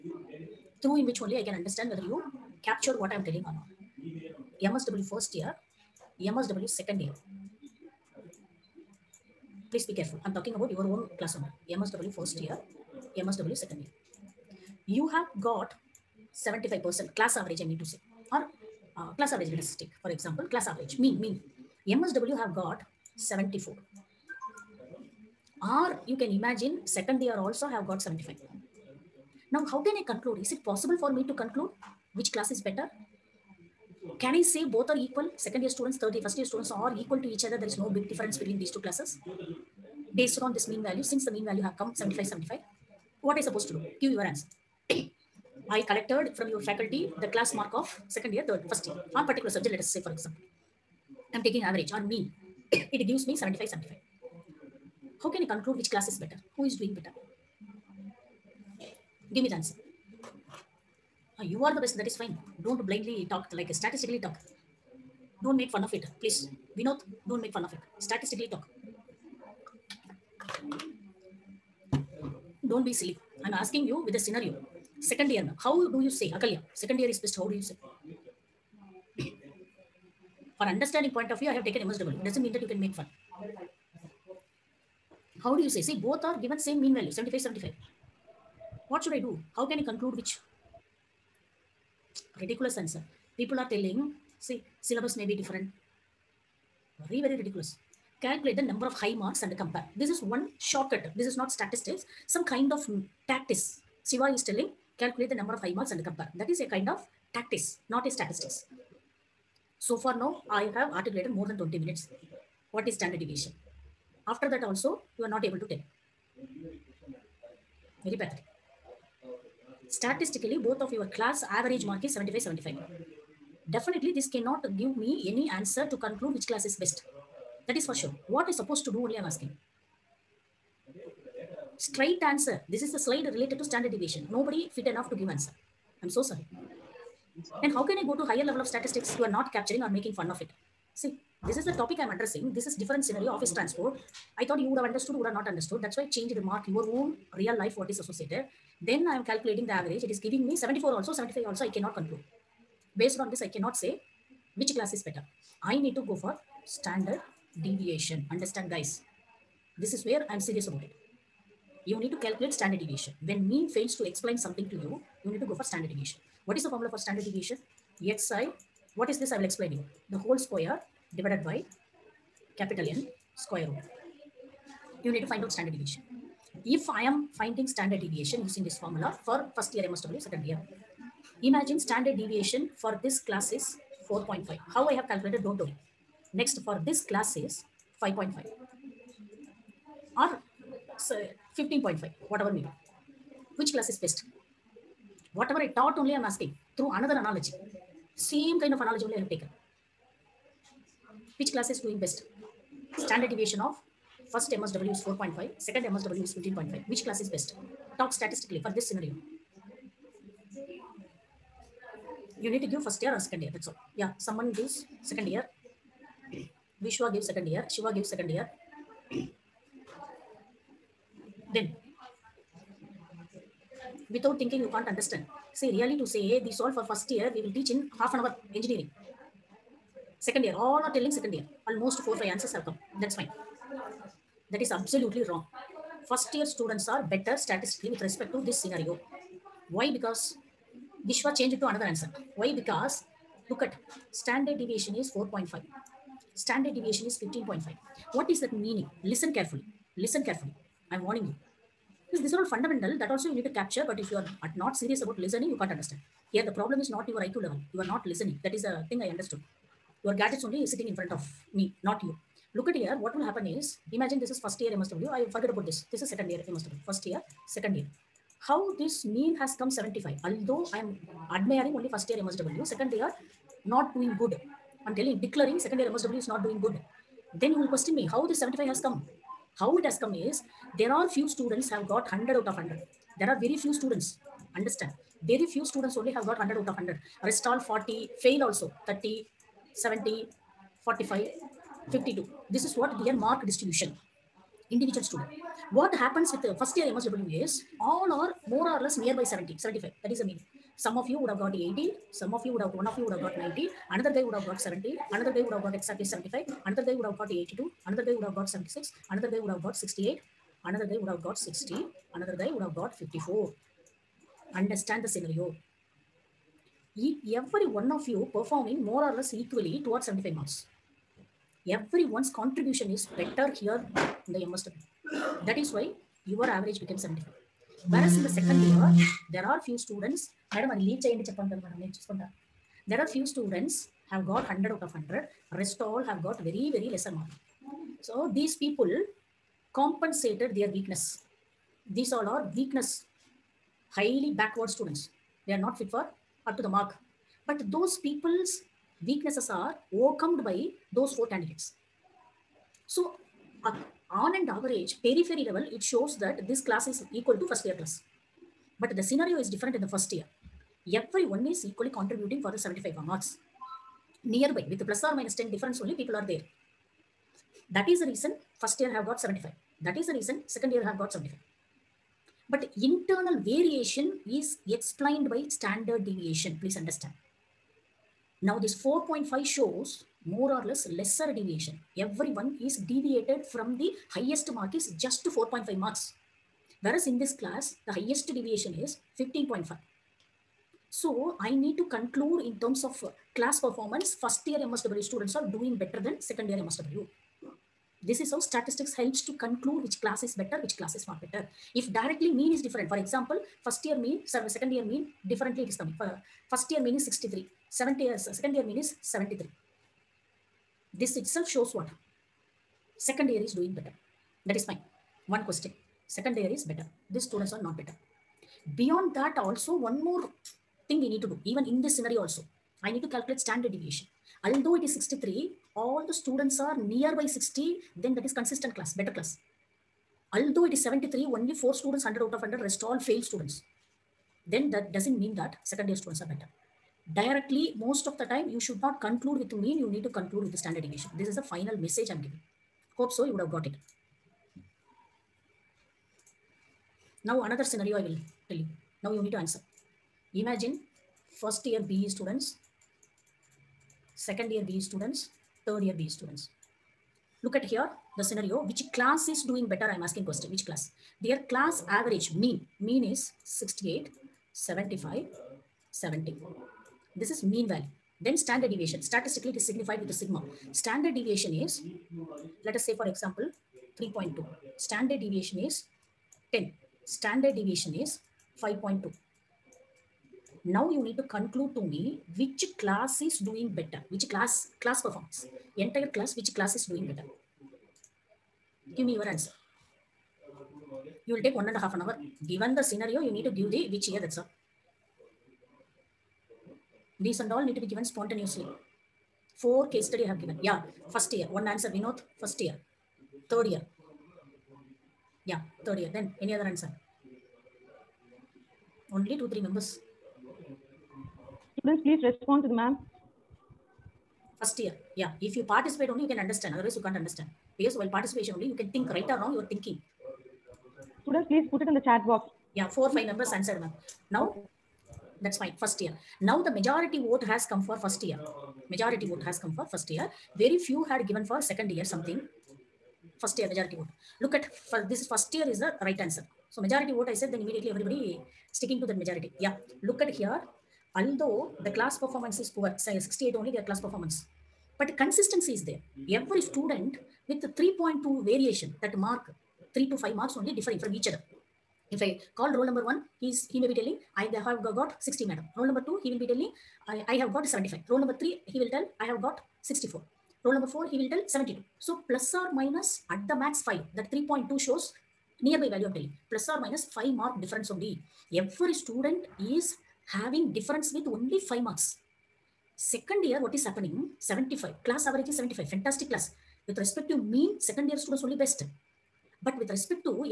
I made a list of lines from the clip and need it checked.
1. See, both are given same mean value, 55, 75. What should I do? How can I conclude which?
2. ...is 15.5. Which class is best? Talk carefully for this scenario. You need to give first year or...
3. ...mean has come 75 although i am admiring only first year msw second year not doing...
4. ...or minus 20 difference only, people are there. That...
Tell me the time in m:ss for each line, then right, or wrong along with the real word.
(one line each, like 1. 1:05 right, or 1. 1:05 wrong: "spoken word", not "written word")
1. 1:25 wrong: "75", not "55"
2. 3:26 wrong: "statistically", not "carefully"
3. 4:29 right
4. 6:05 wrong: "10", not "20".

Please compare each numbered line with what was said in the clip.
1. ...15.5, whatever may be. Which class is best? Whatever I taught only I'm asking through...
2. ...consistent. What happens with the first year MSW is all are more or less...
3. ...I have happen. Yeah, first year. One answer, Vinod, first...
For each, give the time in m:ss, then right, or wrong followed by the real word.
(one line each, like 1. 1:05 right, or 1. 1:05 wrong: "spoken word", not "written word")
1. 3:11 right
2. 4:55 wrong: "student", not "consistent"
3. 8:20 wrong: "given", not "happen".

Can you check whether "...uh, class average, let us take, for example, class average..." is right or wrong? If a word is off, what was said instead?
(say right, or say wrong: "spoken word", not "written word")
right.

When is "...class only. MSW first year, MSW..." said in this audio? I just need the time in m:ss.
0:11.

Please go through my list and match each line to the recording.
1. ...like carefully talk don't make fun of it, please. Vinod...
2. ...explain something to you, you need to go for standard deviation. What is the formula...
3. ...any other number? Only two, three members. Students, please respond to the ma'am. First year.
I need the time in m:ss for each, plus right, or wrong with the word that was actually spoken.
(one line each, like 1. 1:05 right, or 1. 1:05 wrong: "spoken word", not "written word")
1. 1:03 wrong: "statistically", not "carefully"
2. 2:44 right
3. 8:26 wrong: "answer", not "number".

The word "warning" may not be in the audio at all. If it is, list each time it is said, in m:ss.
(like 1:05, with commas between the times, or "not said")
4:11.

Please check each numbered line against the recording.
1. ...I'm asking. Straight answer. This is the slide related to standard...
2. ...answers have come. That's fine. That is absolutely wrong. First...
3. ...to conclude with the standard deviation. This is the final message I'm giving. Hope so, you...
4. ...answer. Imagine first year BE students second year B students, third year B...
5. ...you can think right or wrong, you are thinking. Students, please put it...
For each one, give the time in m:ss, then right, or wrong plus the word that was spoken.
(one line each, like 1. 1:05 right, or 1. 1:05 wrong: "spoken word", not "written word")
1. 2:09 right
2. 3:52 right
3. 7:20 right
4. 7:29 right
5. 8:38 right.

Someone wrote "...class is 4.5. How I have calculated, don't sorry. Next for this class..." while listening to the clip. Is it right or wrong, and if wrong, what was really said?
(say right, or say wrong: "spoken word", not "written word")
wrong: "worry", not "sorry".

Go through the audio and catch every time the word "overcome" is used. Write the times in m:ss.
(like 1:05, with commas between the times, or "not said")
5:49.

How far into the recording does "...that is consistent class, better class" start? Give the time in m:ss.
7:08.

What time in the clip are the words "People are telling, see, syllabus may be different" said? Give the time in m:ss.
1:33.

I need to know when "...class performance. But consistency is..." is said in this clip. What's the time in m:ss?
9:03.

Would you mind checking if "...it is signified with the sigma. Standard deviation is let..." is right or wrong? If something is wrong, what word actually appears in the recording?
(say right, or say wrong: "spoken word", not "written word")
right.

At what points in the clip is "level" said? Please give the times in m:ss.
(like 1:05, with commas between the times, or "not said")
2:18, 4:17, 5:55.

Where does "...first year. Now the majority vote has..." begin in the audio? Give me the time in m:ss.
8:45.